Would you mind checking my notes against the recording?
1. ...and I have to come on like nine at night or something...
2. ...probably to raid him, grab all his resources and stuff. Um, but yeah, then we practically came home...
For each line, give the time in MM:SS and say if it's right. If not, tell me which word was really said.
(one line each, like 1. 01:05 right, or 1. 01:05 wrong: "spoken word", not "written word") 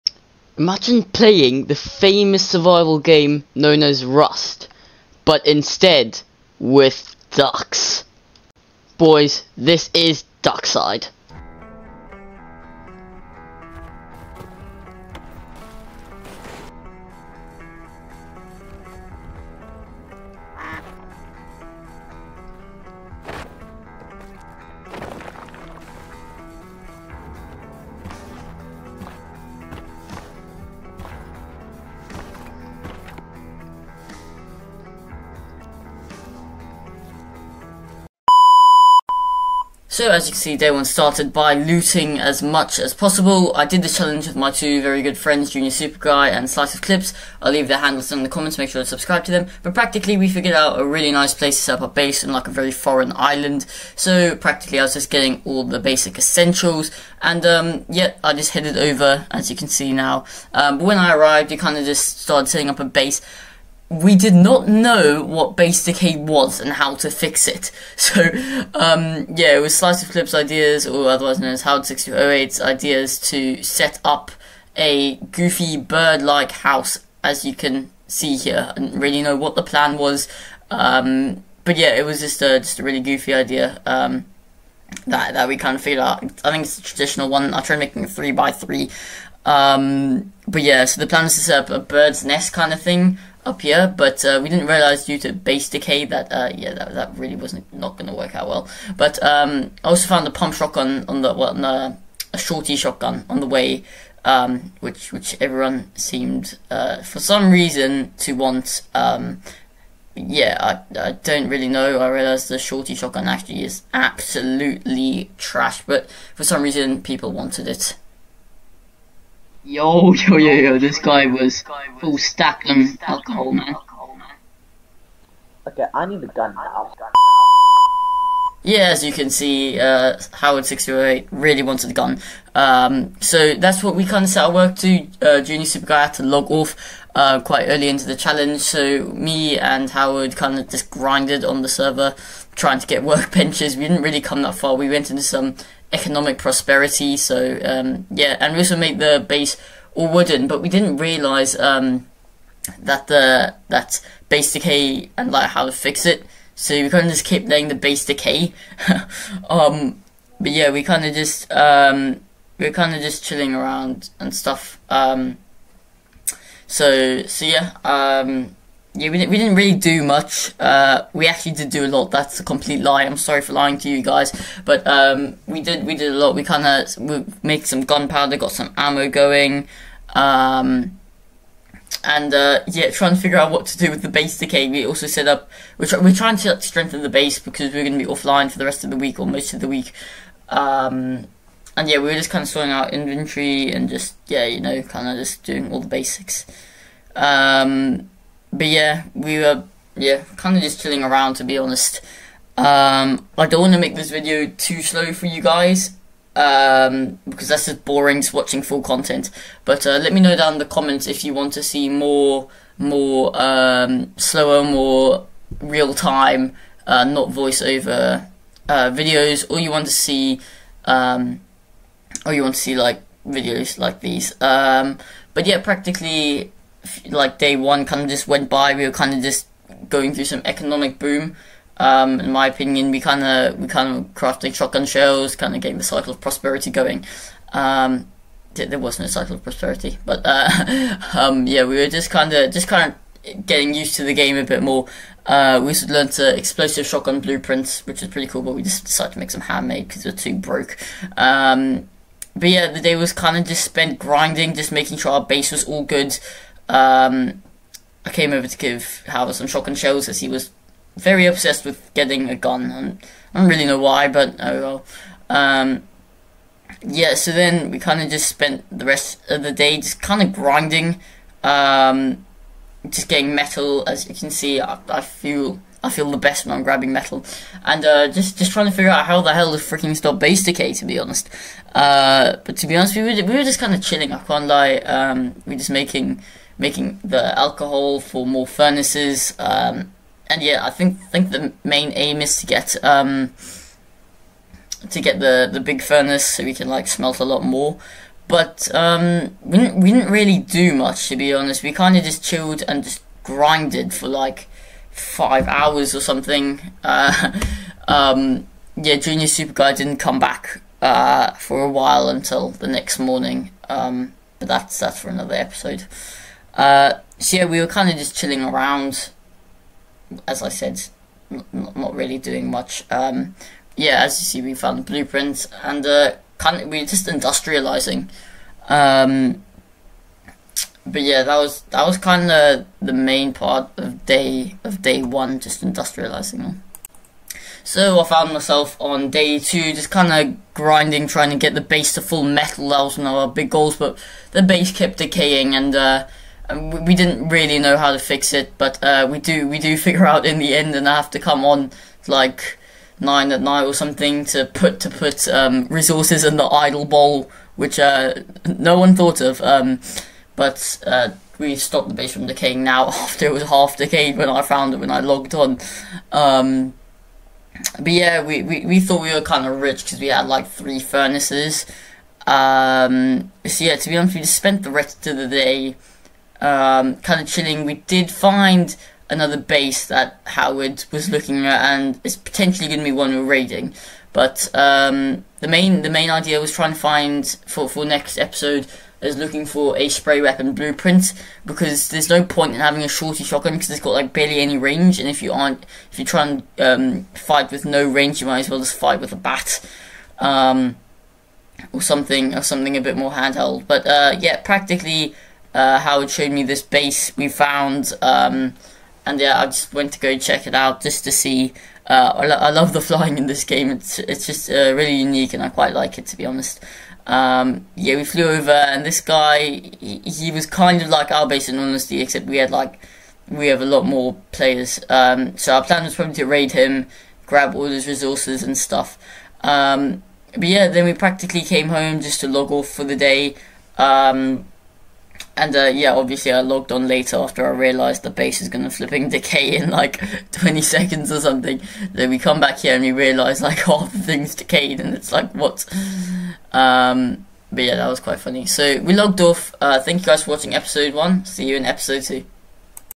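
1. 05:50 right
2. 07:05 right.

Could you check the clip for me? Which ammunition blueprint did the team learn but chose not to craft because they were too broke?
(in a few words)
Explosive shotgun.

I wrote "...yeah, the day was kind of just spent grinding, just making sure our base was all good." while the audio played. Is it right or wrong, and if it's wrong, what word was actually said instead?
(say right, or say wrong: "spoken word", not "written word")
right.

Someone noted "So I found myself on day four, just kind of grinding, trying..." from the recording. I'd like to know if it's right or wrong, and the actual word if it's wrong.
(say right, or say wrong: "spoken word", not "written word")
wrong: "two", not "four".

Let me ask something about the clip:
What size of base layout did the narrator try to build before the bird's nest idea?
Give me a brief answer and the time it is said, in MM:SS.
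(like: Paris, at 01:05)
3 by 3, at 01:28.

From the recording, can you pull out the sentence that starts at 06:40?
Um, or something, or something a bit more handheld.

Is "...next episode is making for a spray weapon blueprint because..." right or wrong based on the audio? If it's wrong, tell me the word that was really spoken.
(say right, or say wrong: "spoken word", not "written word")
wrong: "looking", not "making".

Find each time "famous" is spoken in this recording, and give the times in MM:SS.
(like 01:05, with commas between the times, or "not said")
00:01.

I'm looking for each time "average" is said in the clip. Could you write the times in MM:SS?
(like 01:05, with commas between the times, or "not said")
not said.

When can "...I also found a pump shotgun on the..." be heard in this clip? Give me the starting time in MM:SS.
01:39.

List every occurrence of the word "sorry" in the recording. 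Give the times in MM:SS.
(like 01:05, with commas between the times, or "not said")
02:53.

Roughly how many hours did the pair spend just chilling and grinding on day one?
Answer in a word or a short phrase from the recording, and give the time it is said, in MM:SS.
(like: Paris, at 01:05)
5 hours, at 05:04.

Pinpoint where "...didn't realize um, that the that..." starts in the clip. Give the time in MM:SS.
02:30.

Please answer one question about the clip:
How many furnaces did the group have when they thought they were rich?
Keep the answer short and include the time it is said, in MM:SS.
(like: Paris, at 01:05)
3, at 06:10.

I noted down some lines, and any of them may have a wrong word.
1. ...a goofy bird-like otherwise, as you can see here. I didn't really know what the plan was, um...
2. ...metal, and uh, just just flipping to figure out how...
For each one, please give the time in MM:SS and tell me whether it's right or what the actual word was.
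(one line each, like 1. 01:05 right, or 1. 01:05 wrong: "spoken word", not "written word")
1. 01:14 wrong: "house", not "otherwise"
2. 04:36 wrong: "trying", not "flipping".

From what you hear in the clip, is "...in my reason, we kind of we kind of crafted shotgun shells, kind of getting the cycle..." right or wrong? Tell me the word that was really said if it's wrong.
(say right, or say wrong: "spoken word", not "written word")
wrong: "opinion", not "reason".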